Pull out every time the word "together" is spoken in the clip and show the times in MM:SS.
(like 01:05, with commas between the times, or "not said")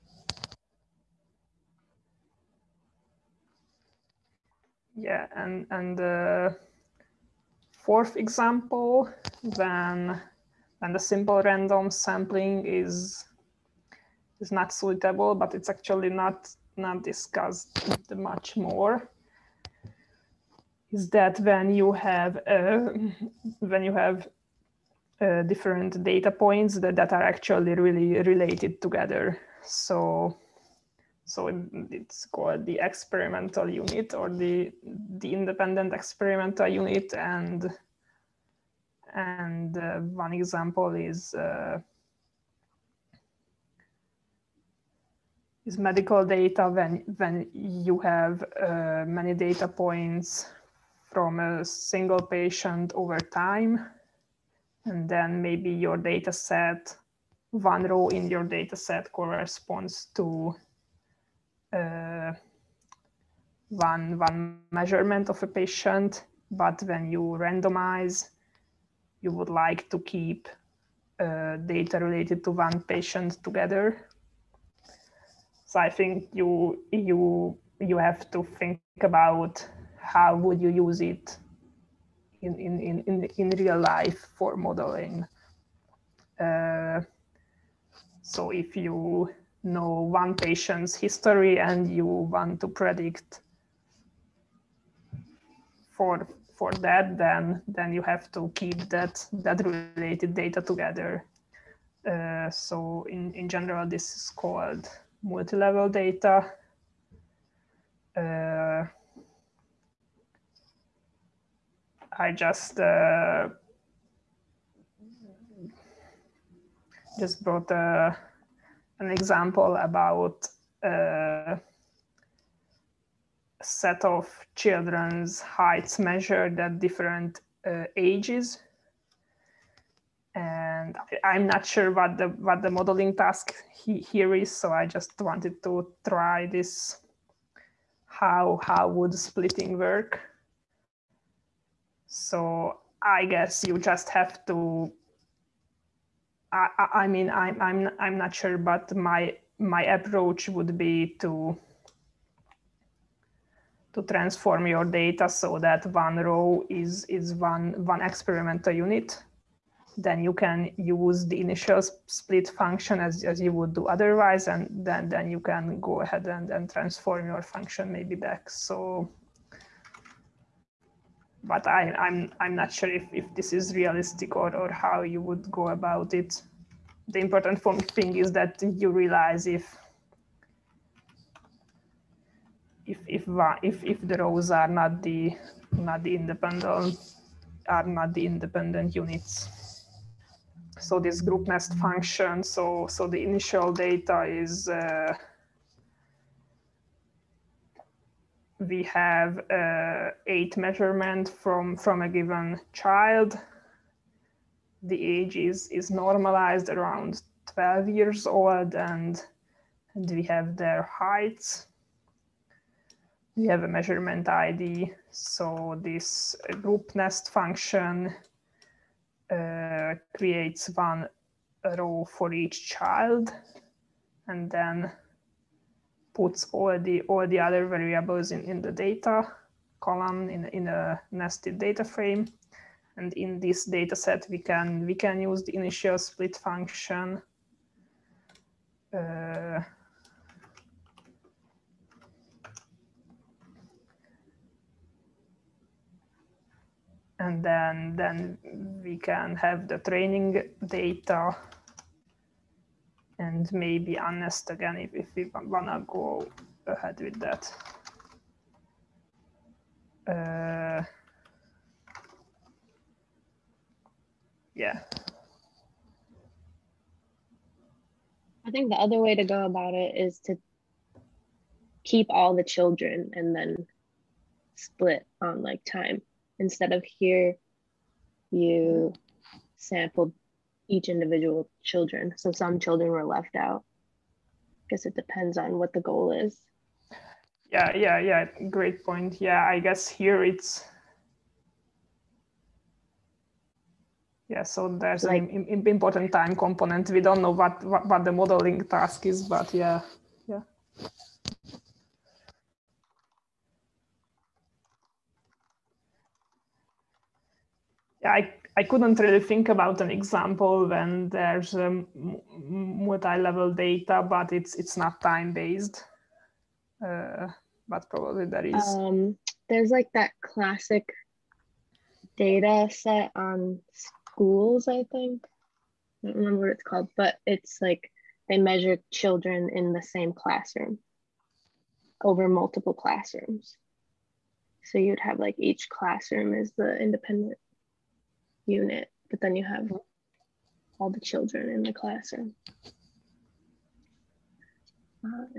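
00:28, 01:13, 01:40.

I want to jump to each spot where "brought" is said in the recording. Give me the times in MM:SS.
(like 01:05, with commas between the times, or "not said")
01:57.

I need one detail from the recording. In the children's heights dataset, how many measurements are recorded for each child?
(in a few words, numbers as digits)
8.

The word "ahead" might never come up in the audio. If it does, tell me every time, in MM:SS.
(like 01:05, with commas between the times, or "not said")
02:46, 04:16.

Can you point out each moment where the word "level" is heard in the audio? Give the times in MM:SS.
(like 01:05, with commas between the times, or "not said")
01:45, 05:12.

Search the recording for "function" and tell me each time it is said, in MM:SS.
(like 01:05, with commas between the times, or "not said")
02:42, 02:47, 03:11, 03:37, 03:56.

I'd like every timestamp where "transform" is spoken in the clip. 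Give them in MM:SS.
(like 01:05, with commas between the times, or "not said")
02:34, 02:46.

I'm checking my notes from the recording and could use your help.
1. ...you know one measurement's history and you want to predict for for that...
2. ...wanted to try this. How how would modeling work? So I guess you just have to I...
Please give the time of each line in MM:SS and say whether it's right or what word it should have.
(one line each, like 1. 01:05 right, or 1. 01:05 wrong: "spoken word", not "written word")
1. 01:28 wrong: "patient", not "measurement"
2. 02:15 wrong: "splitting", not "modeling".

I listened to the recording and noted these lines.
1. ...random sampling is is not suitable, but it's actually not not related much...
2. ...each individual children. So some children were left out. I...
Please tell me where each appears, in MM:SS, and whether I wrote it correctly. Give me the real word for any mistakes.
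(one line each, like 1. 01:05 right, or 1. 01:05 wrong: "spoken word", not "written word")
1. 00:11 wrong: "discussed", not "related"
2. 04:40 right.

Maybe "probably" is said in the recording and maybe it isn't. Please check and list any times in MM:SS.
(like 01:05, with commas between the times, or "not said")
05:17.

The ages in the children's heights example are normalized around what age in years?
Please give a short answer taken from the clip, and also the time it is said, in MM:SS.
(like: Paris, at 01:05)
12, at 03:27.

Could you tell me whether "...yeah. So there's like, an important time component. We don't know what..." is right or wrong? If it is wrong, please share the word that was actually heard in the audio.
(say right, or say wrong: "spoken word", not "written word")
right.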